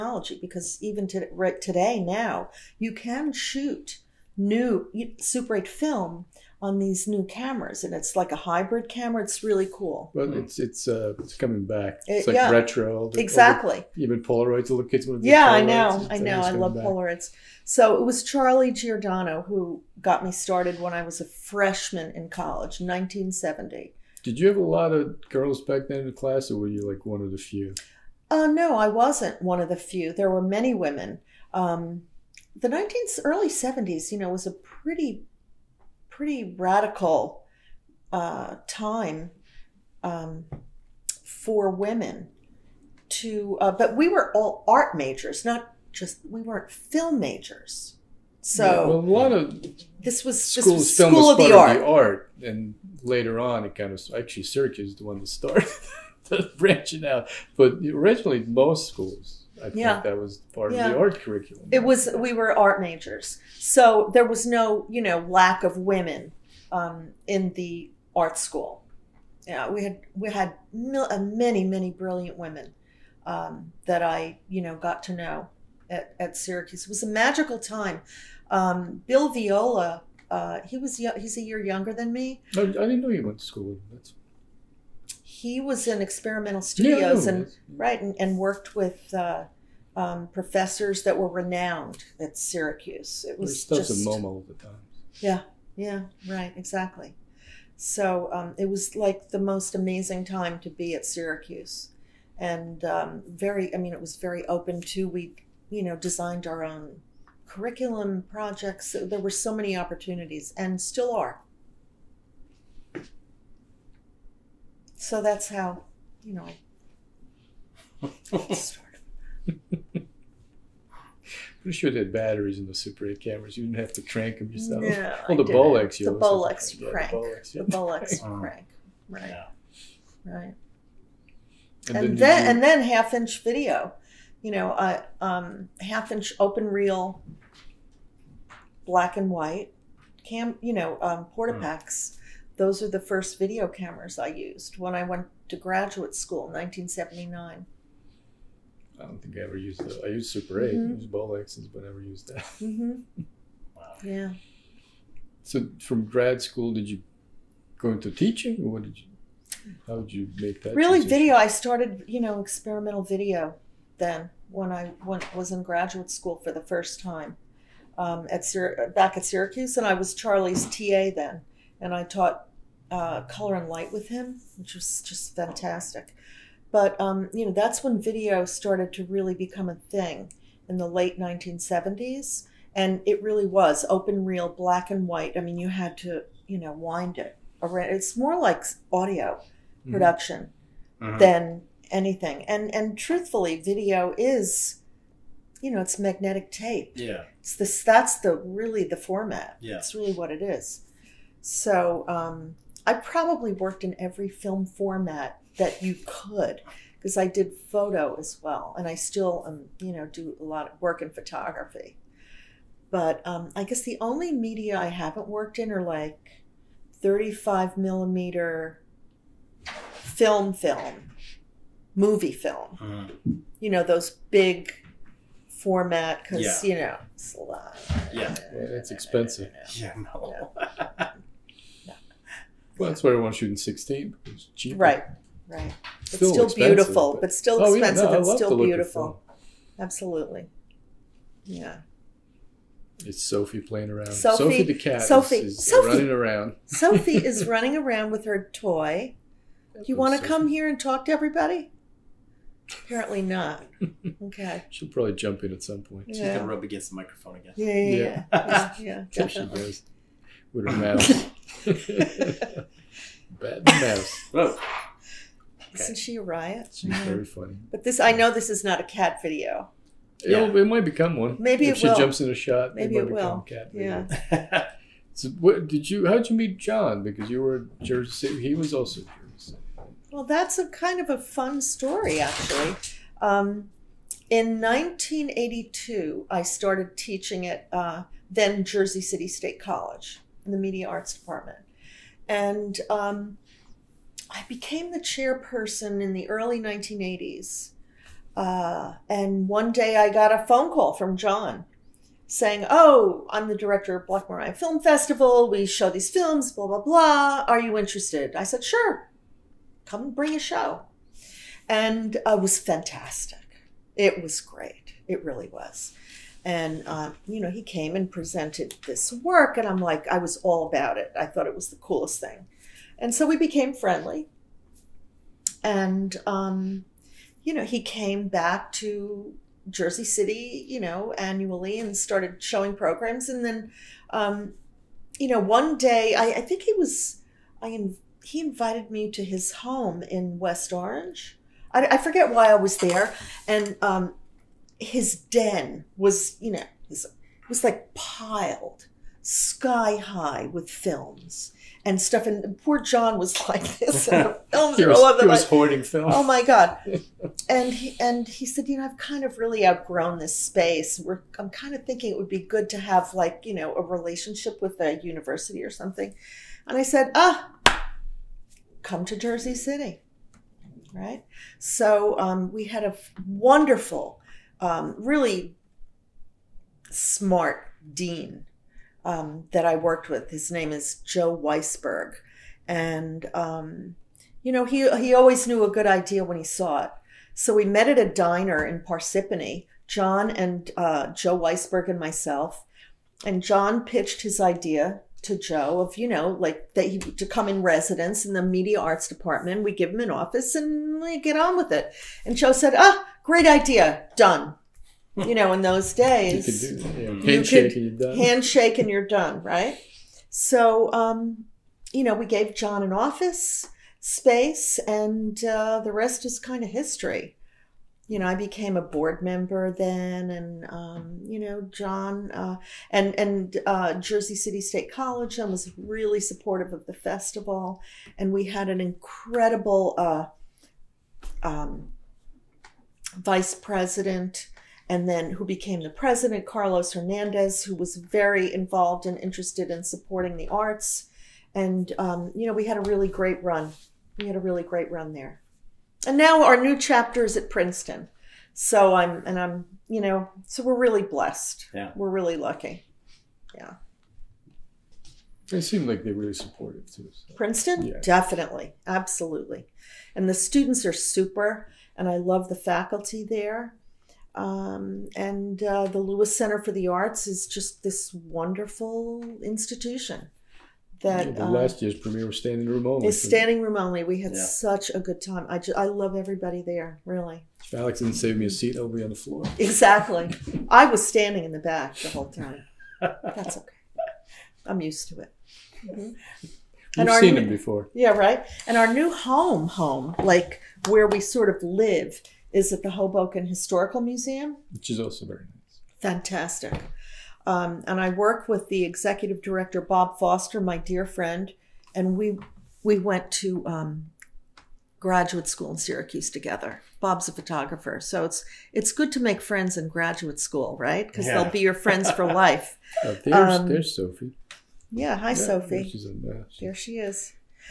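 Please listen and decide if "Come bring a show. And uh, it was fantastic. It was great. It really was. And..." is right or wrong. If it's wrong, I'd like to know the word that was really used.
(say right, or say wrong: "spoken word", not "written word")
right.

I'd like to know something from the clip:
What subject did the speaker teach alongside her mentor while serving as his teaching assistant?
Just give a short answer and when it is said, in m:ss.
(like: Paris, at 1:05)
color and light, at 2:53.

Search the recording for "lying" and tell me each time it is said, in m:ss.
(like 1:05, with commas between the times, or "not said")
not said.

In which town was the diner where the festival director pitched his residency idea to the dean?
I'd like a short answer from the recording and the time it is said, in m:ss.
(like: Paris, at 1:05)
Parsippany, at 6:28.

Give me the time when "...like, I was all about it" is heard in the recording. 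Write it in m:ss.
5:19.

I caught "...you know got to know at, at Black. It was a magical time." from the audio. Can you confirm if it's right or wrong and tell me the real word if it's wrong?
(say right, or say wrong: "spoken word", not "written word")
wrong: "Syracuse", not "Black".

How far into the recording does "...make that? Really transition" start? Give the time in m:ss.
2:40.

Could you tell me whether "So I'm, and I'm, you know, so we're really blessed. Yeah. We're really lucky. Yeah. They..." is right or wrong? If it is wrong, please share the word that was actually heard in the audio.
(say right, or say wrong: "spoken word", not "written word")
right.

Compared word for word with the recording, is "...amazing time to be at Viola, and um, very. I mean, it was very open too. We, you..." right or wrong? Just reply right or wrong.
wrong.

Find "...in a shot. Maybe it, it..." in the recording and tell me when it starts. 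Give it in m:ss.
4:32.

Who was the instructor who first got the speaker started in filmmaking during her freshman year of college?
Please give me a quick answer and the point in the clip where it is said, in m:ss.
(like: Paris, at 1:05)
Charlie Giordano, at 0:18.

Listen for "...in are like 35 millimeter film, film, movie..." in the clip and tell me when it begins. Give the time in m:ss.
3:35.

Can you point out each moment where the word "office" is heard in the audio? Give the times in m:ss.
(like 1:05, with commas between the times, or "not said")
6:40, 6:52.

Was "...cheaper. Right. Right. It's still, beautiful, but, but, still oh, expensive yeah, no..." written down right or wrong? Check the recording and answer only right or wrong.
right.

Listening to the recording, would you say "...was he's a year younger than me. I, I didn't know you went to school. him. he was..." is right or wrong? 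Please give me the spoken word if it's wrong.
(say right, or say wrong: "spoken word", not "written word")
right.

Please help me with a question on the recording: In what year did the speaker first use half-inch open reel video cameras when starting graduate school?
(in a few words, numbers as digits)
1979.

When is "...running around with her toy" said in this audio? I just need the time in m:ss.
4:07.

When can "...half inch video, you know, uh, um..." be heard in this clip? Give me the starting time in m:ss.
2:12.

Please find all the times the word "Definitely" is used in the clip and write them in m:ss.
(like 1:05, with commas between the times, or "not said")
7:38.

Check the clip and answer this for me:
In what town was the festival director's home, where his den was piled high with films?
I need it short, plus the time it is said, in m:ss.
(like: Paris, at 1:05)
West Orange, at 5:40.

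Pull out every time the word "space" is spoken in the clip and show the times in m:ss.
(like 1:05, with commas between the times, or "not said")
6:00, 6:54.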